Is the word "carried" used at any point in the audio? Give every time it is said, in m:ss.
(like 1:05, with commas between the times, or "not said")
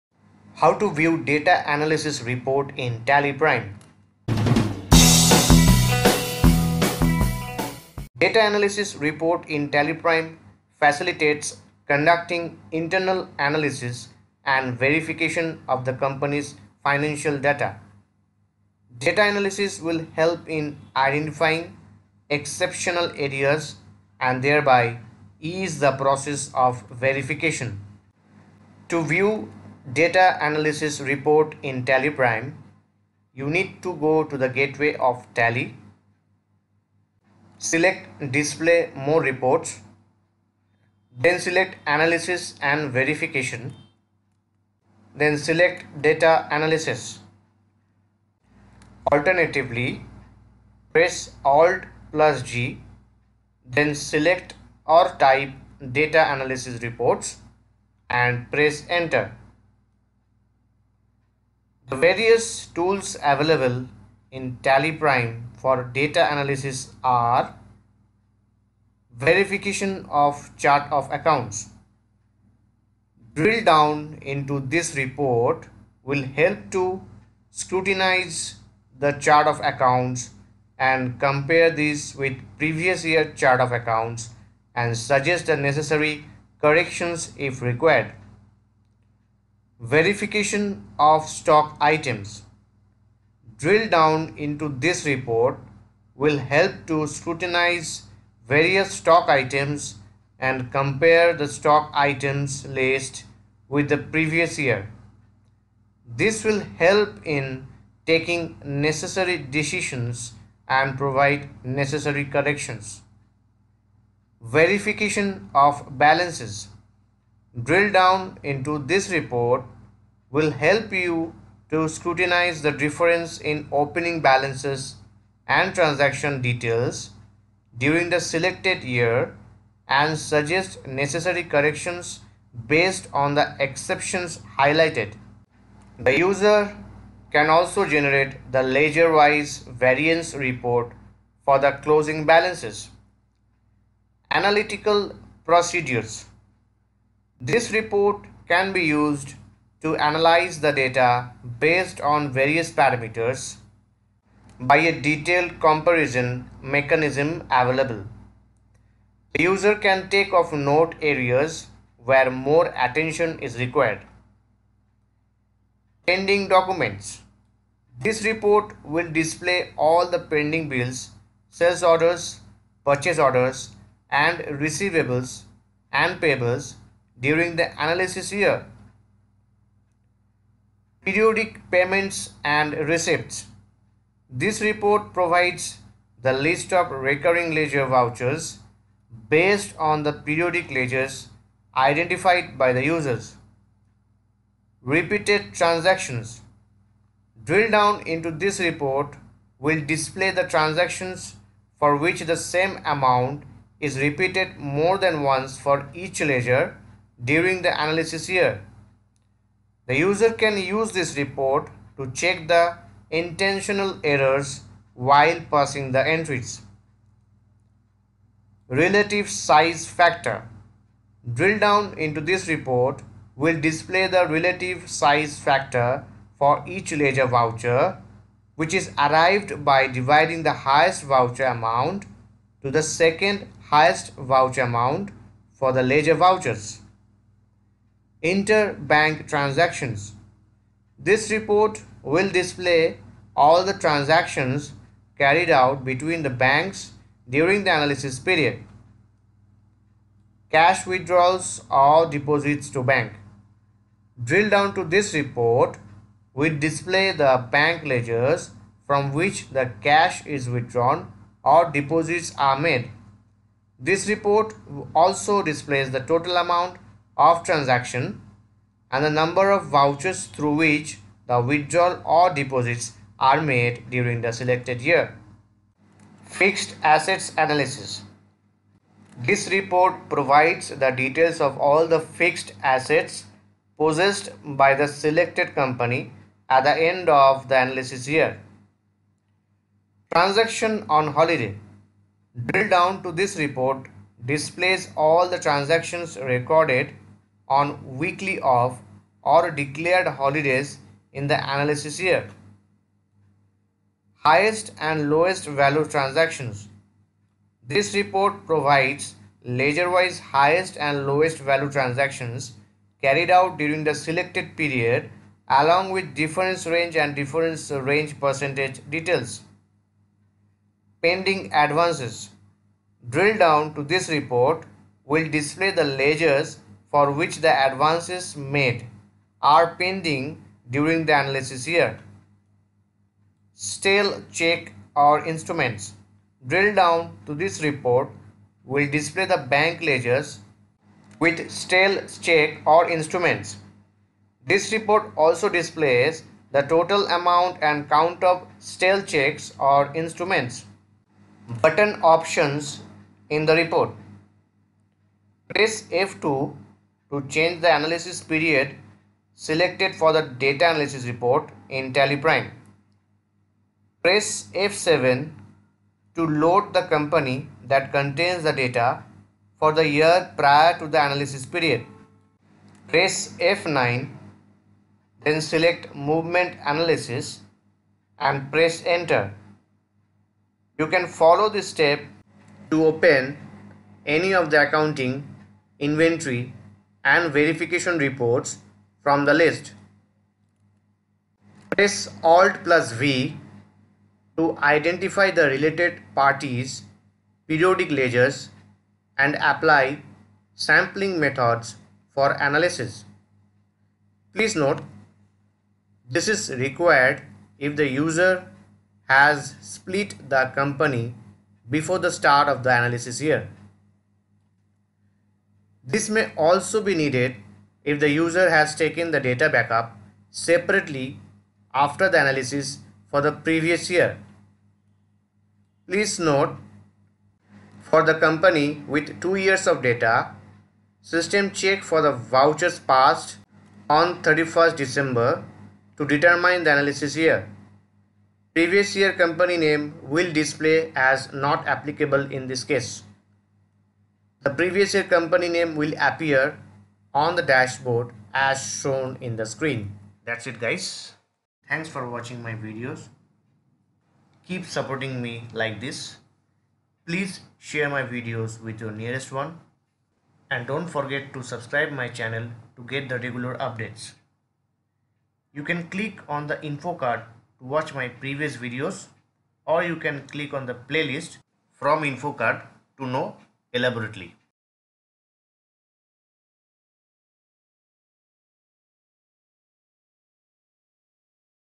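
4:05, 5:13.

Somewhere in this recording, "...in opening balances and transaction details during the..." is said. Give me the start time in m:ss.
2:03.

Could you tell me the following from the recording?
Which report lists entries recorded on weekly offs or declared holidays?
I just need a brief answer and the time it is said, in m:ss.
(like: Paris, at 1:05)
Transaction on holiday, at 4:50.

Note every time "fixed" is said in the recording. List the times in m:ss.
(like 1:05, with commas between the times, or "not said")
4:36, 4:41.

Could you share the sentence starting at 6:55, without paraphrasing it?
This may also be needed if the user has taken the data backup separately after the analysis for the previous year.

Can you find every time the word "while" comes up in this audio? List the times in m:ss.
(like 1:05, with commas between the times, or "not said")
3:34.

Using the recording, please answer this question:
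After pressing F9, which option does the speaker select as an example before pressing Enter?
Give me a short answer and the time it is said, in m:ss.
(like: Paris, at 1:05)
Movement Analysis, at 6:15.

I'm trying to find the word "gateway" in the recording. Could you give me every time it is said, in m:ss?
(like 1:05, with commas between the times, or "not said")
0:34.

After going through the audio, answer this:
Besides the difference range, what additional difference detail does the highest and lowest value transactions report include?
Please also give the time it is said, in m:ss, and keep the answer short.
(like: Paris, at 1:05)
difference range percentage, at 5:17.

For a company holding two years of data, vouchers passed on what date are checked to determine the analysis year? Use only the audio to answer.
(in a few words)
31st December.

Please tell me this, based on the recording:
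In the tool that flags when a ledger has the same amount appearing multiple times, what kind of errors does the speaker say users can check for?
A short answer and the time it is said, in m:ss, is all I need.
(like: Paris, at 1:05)
intentional errors, at 3:33.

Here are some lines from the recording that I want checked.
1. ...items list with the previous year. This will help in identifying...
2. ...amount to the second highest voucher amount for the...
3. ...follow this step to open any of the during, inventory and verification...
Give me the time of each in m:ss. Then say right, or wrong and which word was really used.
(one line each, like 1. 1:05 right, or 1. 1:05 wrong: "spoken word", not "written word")
1. 1:41 wrong: "taking", not "identifying"
2. 3:51 right
3. 6:21 wrong: "accounting", not "during".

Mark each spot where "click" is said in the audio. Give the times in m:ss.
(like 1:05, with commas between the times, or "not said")
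7:45, 7:50.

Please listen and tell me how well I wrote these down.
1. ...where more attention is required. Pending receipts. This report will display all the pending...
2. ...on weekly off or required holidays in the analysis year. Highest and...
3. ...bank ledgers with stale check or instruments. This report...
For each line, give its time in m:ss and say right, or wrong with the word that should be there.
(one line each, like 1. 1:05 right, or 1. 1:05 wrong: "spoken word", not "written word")
1. 2:42 wrong: "documents", not "receipts"
2. 4:57 wrong: "declared", not "required"
3. 5:39 right.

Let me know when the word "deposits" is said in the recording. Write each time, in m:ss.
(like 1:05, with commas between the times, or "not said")
4:12, 4:21, 4:32.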